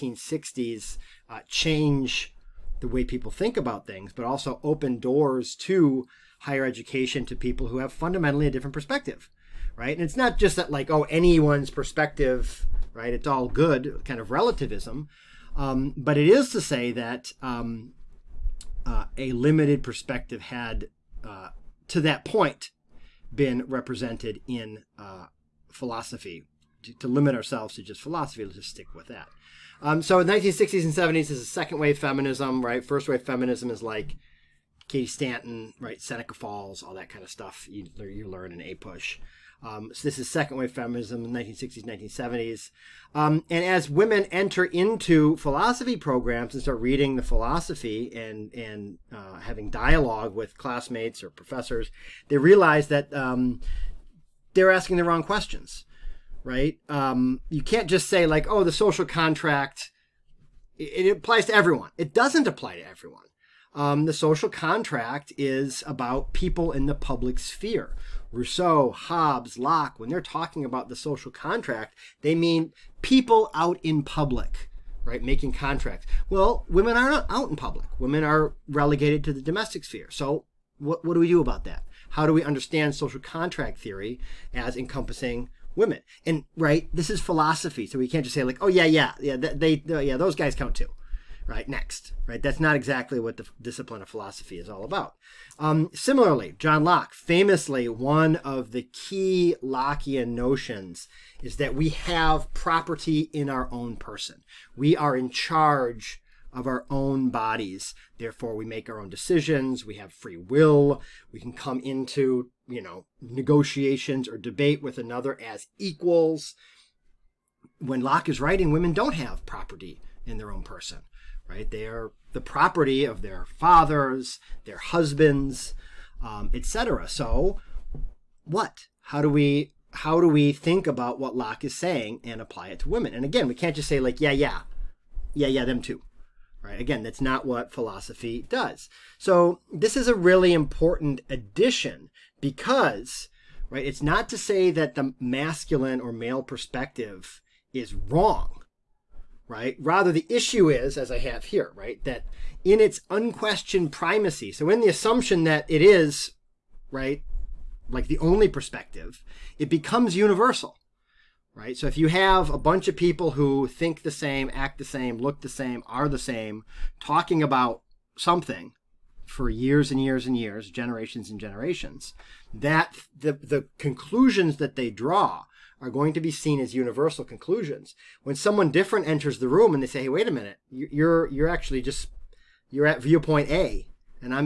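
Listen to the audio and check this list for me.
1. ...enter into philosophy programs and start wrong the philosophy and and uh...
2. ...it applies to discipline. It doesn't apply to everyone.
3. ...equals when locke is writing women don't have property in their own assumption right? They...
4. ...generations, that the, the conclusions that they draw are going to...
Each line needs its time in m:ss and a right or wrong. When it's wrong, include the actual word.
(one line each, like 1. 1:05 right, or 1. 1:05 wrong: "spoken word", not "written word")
1. 0:44 wrong: "reading", not "wrong"
2. 1:01 wrong: "everyone", not "discipline"
3. 1:55 wrong: "person", not "assumption"
4. 2:51 right.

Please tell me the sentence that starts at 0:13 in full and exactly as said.
It's all good, kind of relativism.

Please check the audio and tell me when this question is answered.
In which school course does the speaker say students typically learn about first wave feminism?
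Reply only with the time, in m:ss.
0:38.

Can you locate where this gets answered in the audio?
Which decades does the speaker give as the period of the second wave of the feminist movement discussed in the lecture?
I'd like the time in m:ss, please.
0:30.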